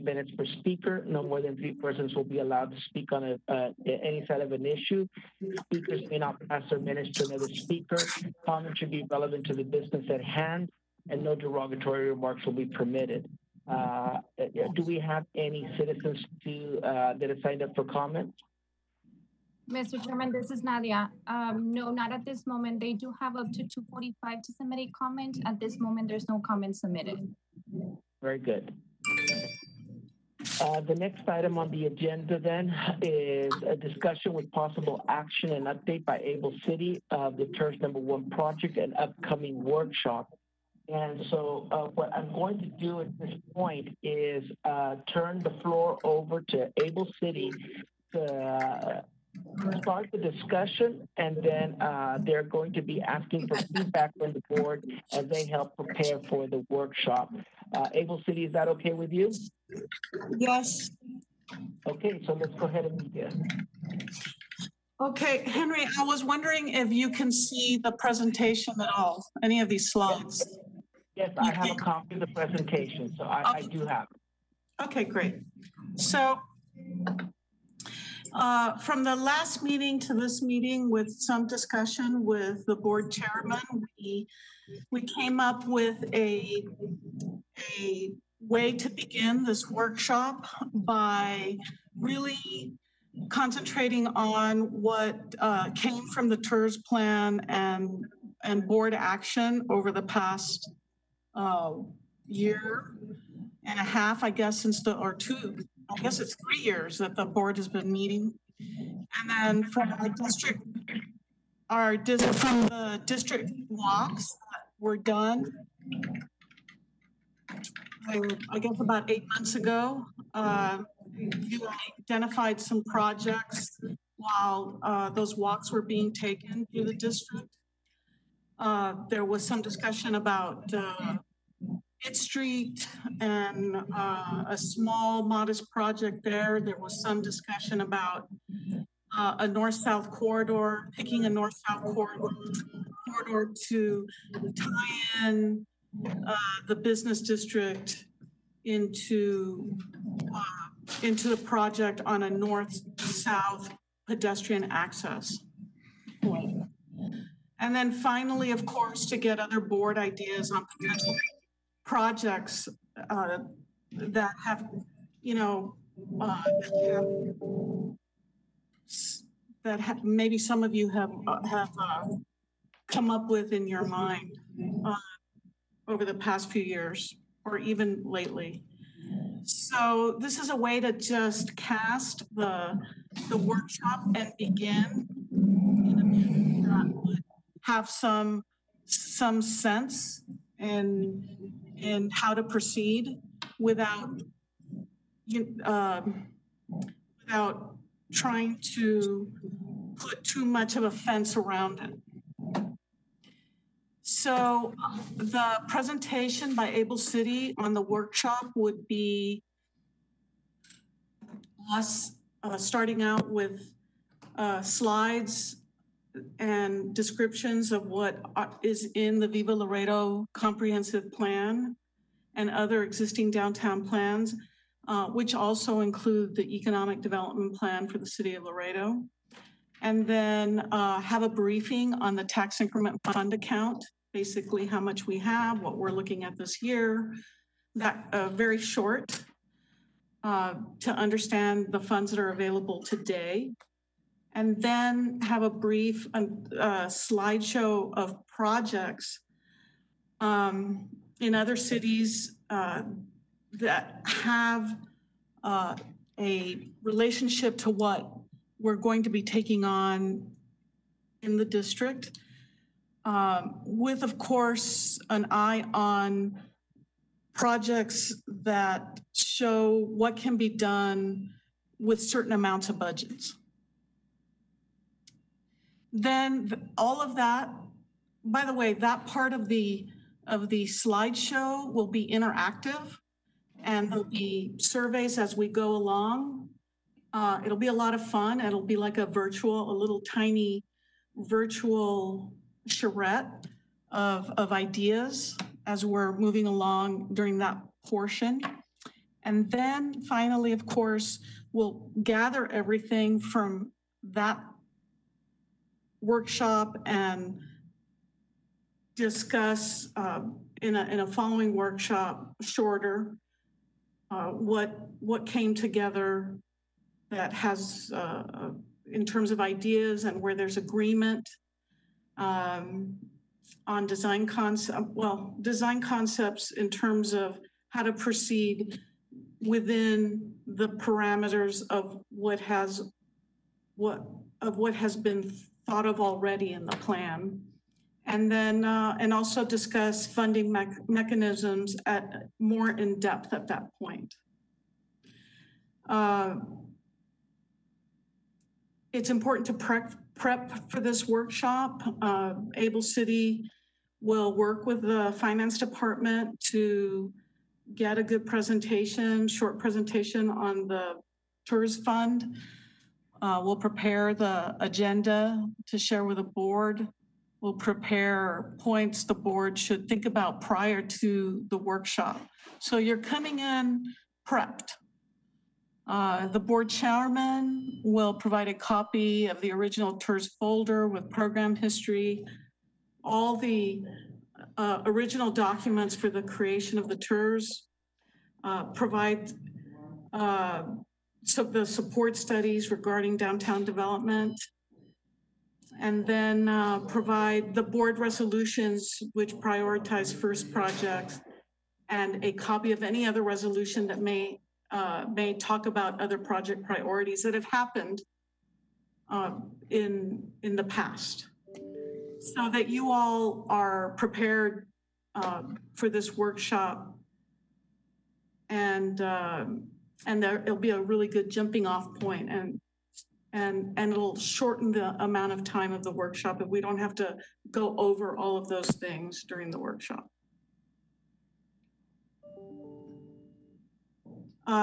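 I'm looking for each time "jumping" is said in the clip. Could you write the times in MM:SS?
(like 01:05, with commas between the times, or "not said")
07:01.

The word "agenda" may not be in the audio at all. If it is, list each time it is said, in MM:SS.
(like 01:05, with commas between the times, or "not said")
00:31, 06:04.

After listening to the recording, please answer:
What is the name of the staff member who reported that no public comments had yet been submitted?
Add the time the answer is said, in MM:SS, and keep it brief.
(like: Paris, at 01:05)
Nadia, at 00:20.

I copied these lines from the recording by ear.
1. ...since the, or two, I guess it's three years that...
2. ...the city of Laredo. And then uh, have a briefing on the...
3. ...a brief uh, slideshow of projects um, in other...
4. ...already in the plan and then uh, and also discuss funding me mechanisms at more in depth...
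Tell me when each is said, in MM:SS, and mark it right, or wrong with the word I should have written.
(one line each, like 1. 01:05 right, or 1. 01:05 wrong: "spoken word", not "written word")
1. 01:44 right
2. 03:47 right
3. 04:05 right
4. 05:35 right.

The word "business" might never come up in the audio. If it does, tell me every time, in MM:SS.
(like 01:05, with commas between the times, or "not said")
00:09, 02:26.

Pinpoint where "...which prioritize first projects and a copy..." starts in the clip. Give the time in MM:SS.
06:39.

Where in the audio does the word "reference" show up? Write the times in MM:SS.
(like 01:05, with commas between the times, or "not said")
not said.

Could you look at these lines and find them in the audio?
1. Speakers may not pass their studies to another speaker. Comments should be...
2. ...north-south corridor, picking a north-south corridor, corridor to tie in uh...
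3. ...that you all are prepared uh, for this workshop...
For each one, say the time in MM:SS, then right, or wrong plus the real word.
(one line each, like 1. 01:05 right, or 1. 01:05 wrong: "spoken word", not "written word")
1. 00:05 wrong: "minutes", not "studies"
2. 02:19 right
3. 06:52 right.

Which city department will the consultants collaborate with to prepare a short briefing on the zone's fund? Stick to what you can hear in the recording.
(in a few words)
finance department.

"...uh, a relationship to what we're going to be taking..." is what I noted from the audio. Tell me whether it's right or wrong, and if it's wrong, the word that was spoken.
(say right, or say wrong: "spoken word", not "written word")
right.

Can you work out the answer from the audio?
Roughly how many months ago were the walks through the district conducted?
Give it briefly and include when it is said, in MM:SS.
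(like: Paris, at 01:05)
8, at 01:59.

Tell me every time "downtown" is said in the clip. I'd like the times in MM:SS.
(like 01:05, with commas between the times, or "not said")
03:43, 06:33.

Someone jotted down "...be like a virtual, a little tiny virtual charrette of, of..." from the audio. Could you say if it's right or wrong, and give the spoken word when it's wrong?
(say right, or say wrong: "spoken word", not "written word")
right.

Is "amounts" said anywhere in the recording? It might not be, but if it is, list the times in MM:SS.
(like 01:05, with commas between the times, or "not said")
04:32, 07:05.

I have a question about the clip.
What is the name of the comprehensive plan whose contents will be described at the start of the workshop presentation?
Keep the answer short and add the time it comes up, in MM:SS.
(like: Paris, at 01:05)
Viva Laredo, at 03:39.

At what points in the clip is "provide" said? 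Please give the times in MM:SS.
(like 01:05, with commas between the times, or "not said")
06:18, 06:28, 06:36.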